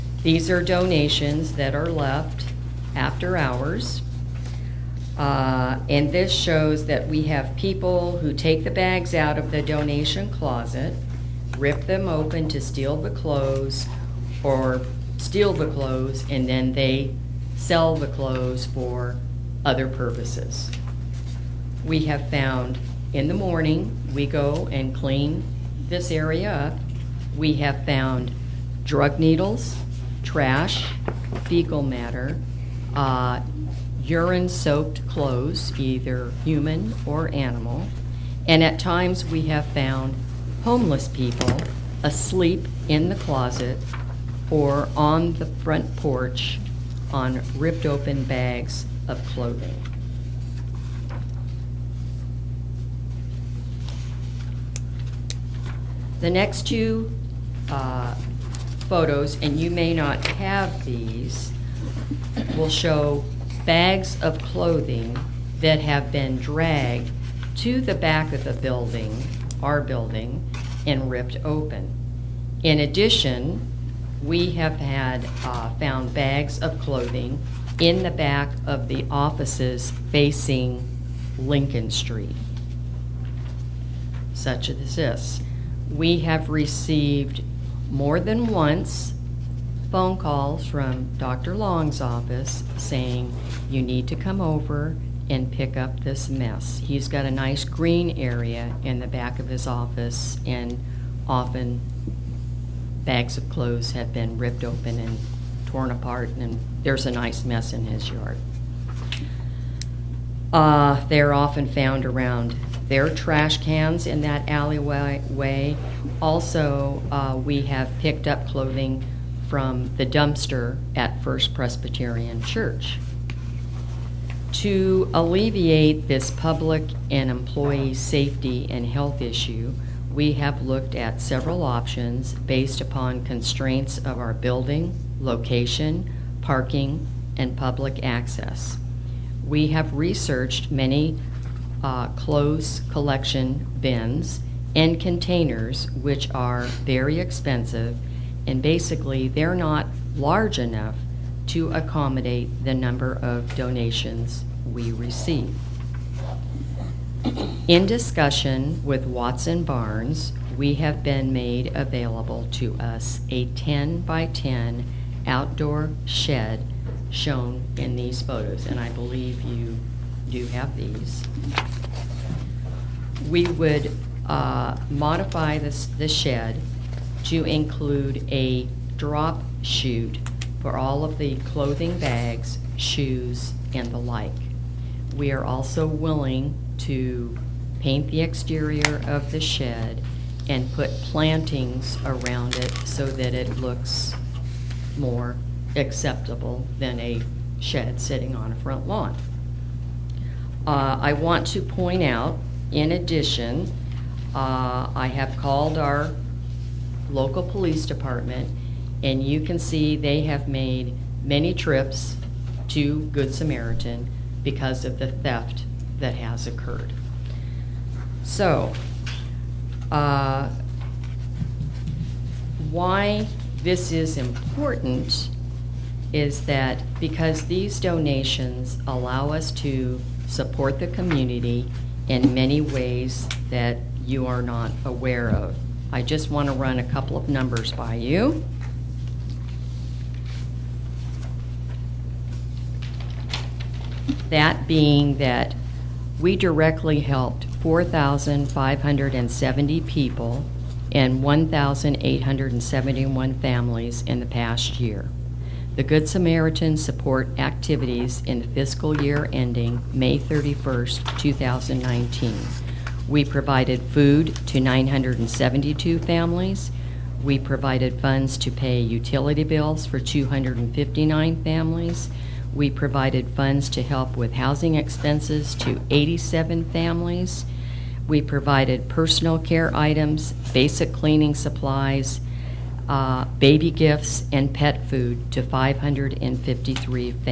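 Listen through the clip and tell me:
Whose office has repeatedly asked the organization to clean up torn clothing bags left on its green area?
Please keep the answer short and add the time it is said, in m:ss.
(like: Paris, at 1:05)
Dr. Long's office, at 1:31.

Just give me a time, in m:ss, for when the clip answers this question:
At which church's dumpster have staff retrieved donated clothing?
2:01.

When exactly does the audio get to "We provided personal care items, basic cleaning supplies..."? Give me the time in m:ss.
4:38.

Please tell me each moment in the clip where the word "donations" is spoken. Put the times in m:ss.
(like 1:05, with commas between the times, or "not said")
0:00, 0:09, 2:33, 3:47.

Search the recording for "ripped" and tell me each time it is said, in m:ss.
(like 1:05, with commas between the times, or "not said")
0:47, 1:11, 1:44.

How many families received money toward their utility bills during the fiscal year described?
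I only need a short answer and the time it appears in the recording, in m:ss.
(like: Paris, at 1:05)
259, at 4:29.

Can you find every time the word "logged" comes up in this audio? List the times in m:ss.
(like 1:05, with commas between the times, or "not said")
not said.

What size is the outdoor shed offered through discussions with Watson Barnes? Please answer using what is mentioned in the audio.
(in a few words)
10 by 10.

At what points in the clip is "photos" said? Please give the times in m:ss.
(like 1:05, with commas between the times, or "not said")
0:58, 2:48.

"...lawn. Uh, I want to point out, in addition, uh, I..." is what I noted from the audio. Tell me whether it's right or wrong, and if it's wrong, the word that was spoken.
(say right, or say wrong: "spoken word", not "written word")
right.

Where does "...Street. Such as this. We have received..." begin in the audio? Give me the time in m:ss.
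1:21.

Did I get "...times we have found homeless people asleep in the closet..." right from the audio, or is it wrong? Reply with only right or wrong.
right.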